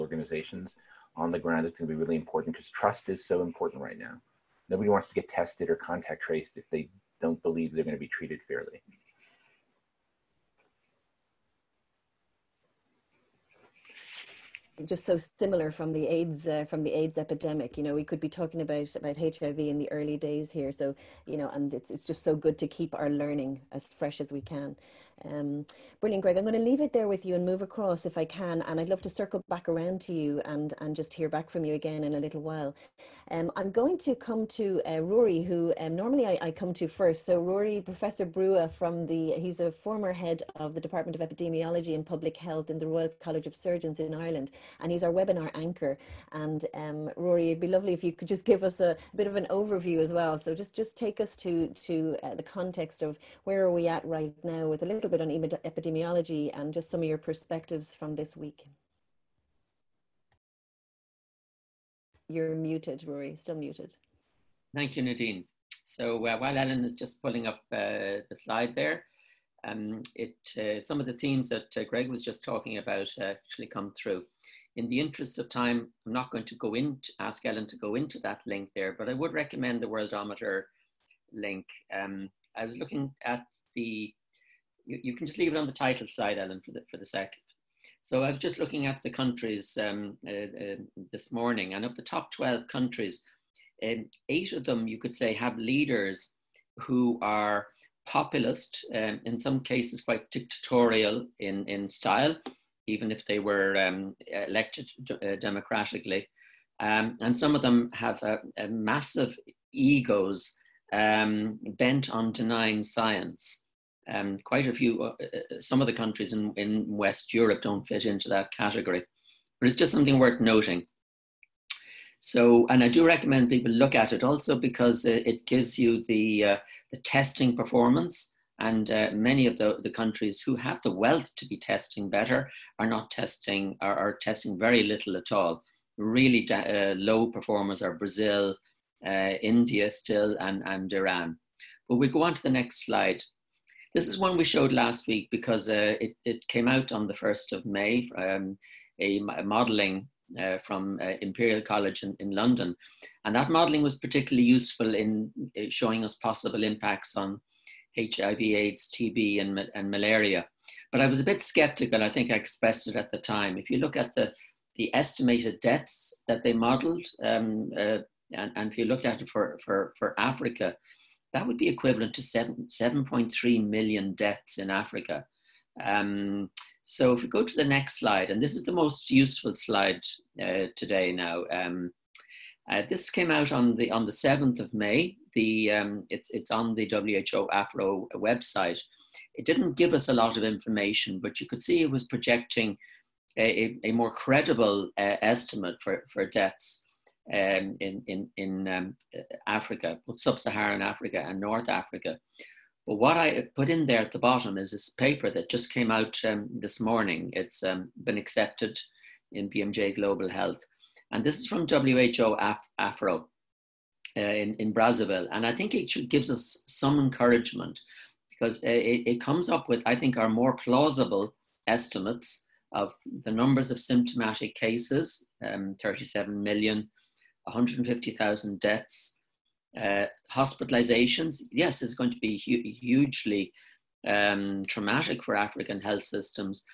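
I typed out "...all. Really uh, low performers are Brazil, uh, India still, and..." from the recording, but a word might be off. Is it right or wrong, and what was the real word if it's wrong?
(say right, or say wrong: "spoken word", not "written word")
right.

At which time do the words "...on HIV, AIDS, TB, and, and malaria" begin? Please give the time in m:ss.
2:37.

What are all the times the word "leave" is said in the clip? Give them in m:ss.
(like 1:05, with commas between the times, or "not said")
0:26, 1:25.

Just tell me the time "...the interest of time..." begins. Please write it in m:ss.
1:14.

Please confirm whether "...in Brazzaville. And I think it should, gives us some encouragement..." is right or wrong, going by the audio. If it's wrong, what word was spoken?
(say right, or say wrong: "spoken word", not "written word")
right.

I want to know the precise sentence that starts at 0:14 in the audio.
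just so similar from the AIDS uh, from the AIDS epidemic.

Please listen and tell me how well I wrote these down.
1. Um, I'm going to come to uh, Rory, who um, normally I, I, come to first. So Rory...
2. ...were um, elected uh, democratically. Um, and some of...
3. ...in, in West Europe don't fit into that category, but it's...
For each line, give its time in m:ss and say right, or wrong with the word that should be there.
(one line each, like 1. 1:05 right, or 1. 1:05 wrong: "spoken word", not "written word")
1. 0:33 right
2. 1:43 right
3. 1:56 right.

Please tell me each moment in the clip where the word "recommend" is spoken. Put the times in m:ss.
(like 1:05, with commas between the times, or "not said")
1:19, 2:03.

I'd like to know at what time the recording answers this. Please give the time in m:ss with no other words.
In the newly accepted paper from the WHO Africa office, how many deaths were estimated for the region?
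3:47.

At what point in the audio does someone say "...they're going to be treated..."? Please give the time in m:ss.
0:07.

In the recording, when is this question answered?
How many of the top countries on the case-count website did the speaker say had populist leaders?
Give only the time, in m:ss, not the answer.
1:32.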